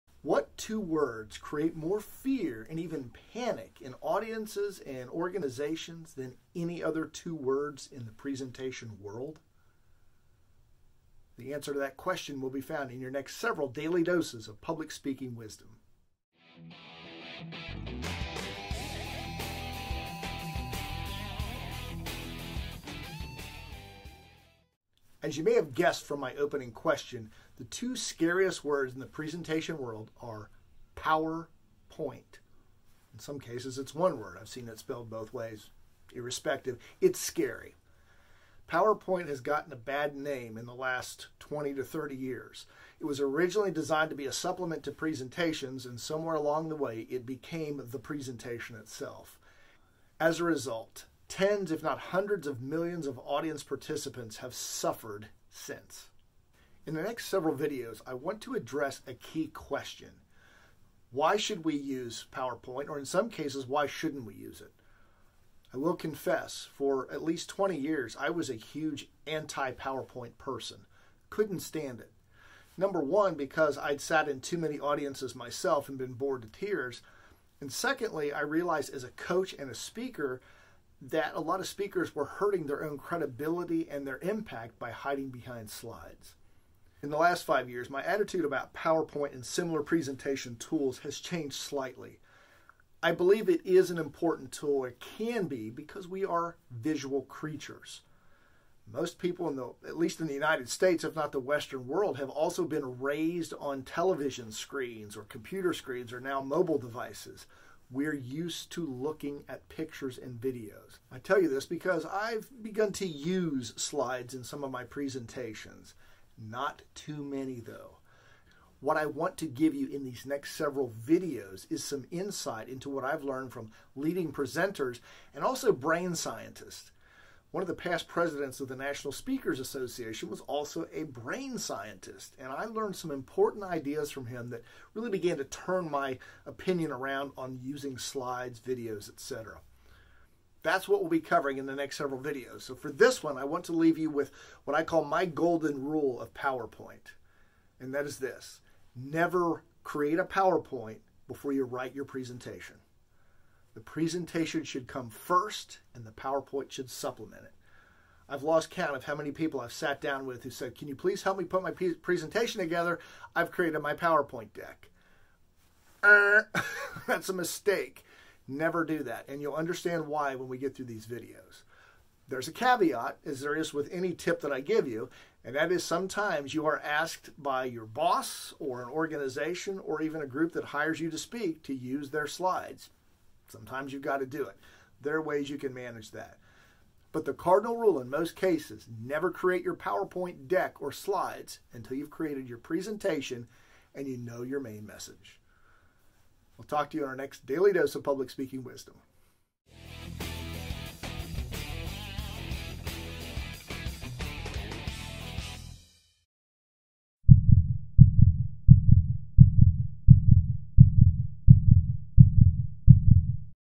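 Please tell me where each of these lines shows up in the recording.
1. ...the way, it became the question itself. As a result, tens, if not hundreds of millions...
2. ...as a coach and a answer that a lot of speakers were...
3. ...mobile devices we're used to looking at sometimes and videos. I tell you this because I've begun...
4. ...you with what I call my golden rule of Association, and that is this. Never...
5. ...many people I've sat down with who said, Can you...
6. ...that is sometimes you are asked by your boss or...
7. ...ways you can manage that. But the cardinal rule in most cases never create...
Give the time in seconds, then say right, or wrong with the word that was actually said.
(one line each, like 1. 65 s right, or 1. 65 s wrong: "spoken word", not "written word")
1. 46 s wrong: "presentation", not "question"
2. 78 s wrong: "speaker", not "answer"
3. 106 s wrong: "pictures", not "sometimes"
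4. 143 s wrong: "PowerPoint", not "Association"
5. 159 s right
6. 175 s right
7. 185 s right.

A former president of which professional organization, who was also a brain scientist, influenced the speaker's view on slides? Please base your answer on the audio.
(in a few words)
National Speakers Association.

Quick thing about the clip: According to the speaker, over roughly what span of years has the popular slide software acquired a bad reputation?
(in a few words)
20 to 30 years.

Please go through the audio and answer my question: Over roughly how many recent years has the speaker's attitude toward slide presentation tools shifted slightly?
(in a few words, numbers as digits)
5 years.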